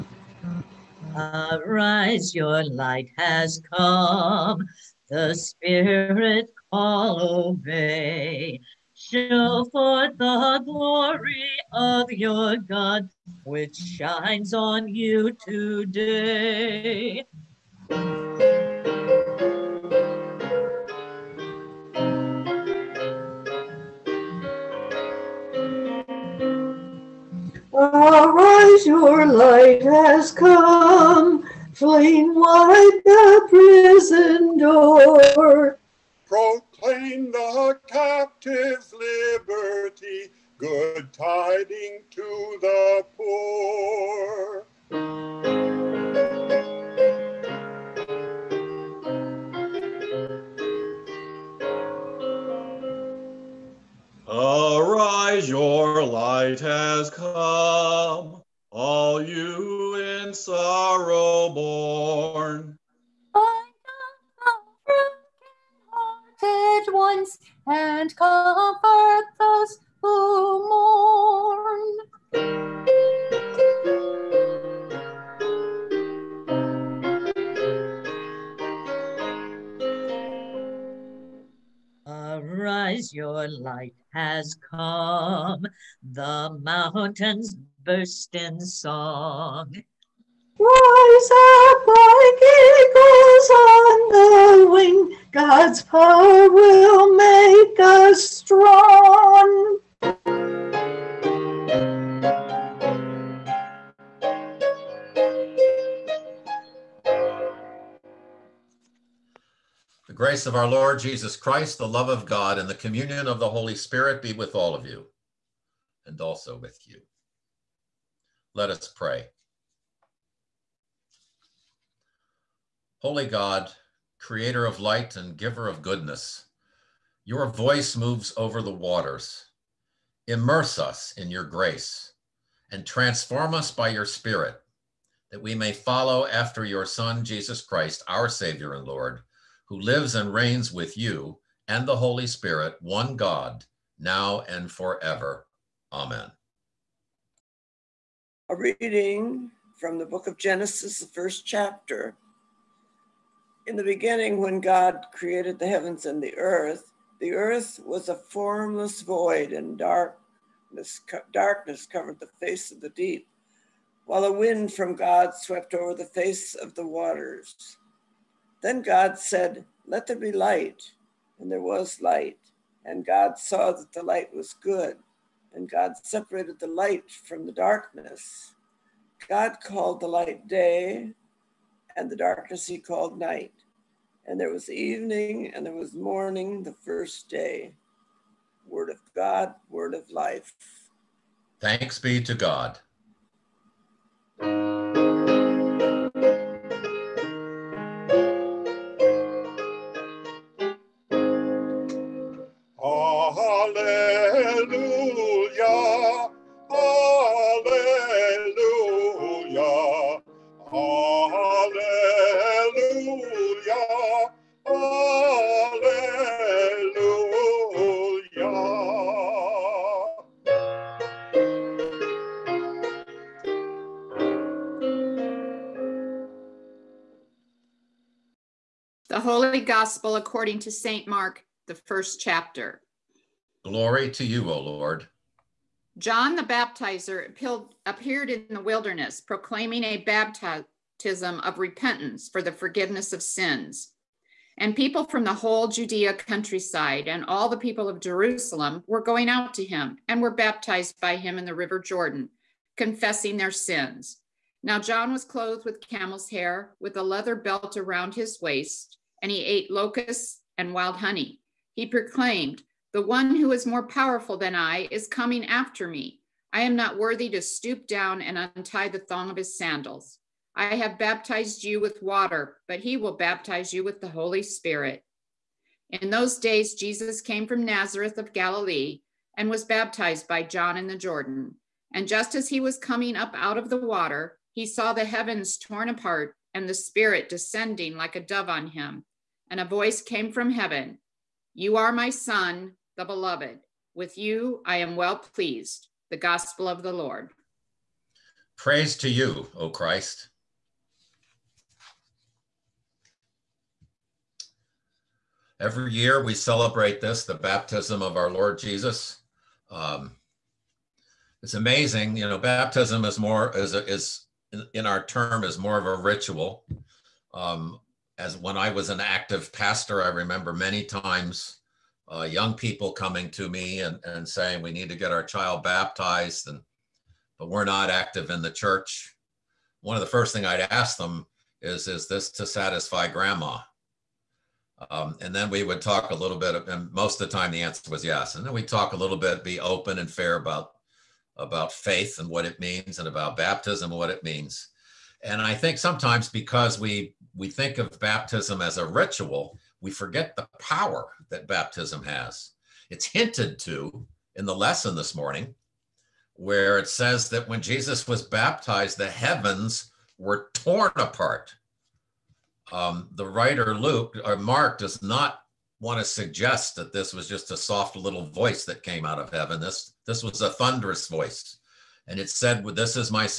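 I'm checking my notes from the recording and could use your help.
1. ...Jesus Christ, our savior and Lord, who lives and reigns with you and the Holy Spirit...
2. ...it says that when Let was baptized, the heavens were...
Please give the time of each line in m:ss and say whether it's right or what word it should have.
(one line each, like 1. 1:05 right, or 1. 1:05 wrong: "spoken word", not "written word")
1. 2:17 right
2. 5:56 wrong: "Jesus", not "Let".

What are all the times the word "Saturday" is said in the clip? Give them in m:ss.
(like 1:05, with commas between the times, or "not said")
not said.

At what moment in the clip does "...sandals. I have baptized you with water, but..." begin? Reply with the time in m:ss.
4:29.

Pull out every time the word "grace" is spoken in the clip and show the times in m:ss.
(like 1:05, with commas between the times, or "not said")
1:50, 2:11.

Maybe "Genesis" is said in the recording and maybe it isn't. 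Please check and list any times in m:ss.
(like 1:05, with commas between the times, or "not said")
2:30.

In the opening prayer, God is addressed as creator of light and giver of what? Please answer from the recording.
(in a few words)
goodness.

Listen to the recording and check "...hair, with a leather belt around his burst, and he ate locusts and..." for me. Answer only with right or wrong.
wrong.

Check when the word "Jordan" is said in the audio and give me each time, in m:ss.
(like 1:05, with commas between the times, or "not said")
4:11, 4:40.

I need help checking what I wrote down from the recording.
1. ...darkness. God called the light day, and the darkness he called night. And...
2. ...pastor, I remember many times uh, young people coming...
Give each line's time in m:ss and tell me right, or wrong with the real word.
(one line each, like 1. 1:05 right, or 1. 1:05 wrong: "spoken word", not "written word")
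1. 2:57 right
2. 5:19 right.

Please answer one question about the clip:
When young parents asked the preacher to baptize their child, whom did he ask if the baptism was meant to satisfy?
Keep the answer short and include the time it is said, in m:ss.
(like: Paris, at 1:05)
grandma, at 5:33.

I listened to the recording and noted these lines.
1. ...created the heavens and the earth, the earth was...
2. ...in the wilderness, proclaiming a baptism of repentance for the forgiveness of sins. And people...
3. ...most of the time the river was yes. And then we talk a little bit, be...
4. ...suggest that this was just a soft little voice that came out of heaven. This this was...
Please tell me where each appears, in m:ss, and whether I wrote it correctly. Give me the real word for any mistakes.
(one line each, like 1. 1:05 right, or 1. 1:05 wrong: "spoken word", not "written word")
1. 2:35 right
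2. 3:58 right
3. 5:36 wrong: "answer", not "river"
4. 6:06 right.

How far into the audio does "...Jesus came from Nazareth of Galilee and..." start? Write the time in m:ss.
4:36.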